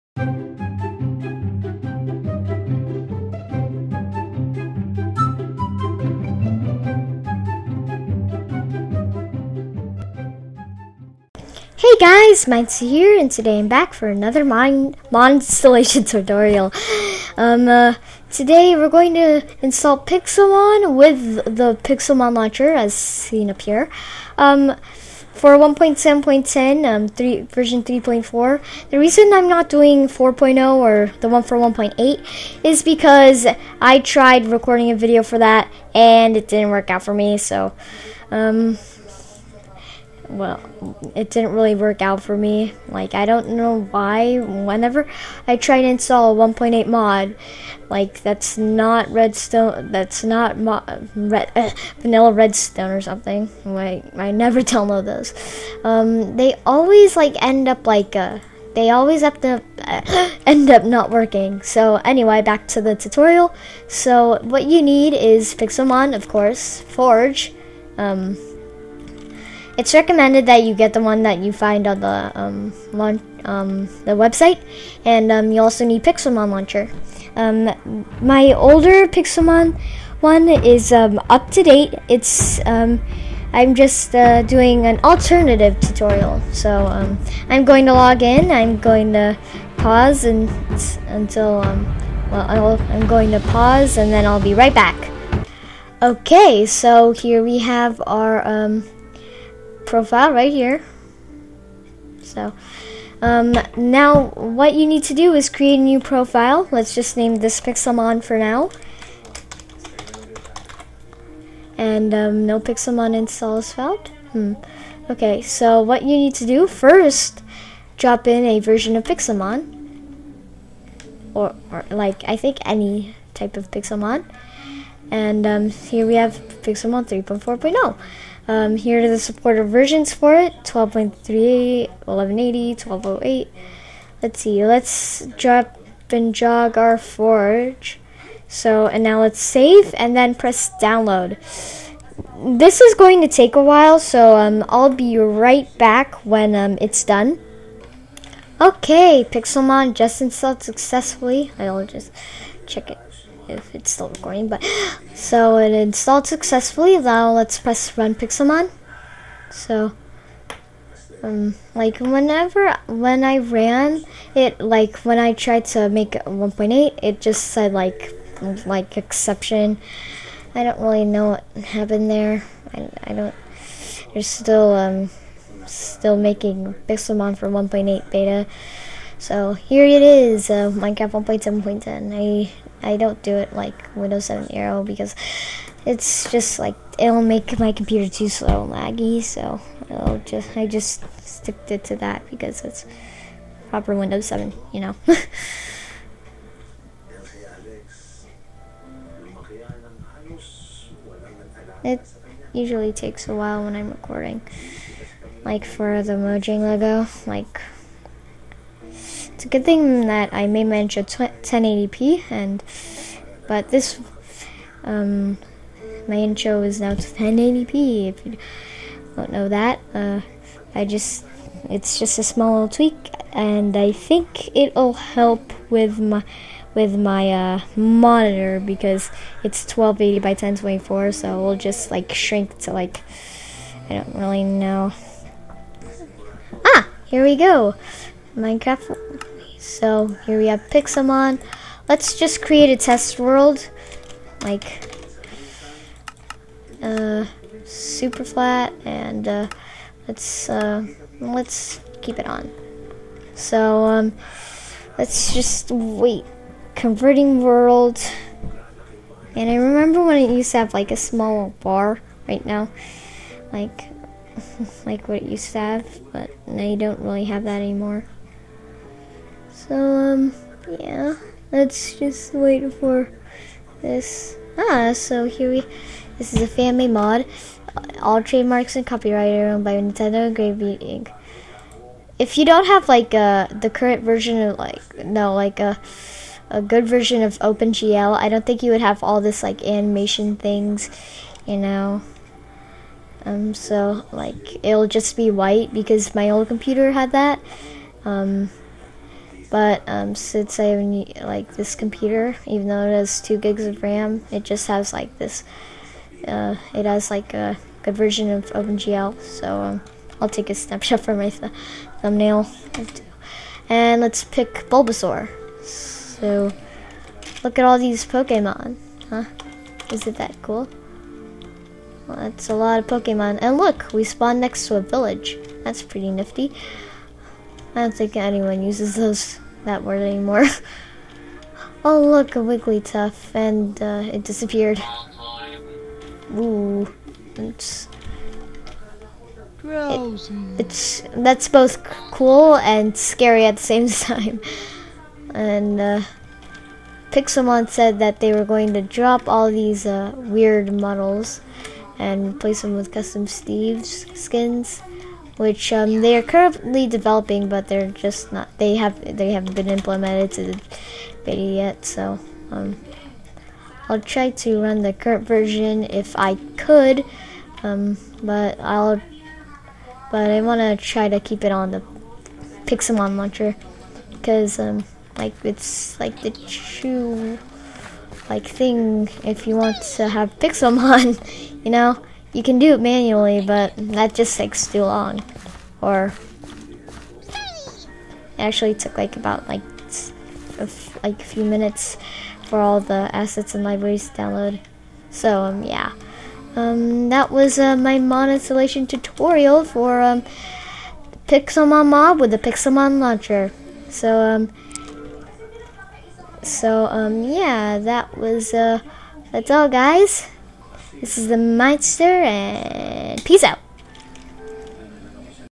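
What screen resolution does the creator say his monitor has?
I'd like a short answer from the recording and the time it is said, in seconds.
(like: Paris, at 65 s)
1280 by 1024, at 229 s.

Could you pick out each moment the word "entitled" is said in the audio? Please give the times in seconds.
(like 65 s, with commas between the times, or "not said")
not said.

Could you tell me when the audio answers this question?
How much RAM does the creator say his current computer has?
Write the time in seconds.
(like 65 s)
303 s.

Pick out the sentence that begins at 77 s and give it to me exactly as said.
Um, my older Pixelmon one is um, up to date.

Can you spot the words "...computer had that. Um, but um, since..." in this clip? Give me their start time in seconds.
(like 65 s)
296 s.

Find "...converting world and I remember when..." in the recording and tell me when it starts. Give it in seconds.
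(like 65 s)
256 s.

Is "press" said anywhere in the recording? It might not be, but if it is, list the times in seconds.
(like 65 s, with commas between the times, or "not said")
140 s, 157 s.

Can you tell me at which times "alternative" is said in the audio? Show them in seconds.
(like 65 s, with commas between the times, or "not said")
85 s.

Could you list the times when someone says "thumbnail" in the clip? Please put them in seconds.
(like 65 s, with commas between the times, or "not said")
312 s.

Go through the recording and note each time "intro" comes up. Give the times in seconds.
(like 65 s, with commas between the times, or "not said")
210 s, 216 s.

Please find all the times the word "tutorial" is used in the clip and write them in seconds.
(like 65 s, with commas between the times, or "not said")
16 s, 62 s, 85 s, 398 s.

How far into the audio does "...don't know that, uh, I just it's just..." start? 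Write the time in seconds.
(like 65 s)
219 s.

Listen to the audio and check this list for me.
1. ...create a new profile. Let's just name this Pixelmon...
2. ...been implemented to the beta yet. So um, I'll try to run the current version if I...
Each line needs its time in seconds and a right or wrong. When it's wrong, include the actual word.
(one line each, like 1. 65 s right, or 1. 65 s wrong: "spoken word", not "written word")
1. 105 s right
2. 359 s right.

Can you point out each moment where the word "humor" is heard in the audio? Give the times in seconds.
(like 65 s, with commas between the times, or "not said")
not said.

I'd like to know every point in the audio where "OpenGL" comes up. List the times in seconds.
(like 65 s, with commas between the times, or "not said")
287 s, 308 s.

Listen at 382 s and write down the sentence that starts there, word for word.
You can do it manually, but that just takes too long.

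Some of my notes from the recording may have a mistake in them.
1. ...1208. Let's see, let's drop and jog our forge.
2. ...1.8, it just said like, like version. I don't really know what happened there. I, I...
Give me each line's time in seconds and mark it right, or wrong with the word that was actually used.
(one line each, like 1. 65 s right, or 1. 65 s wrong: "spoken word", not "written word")
1. 132 s right
2. 166 s wrong: "exception", not "version".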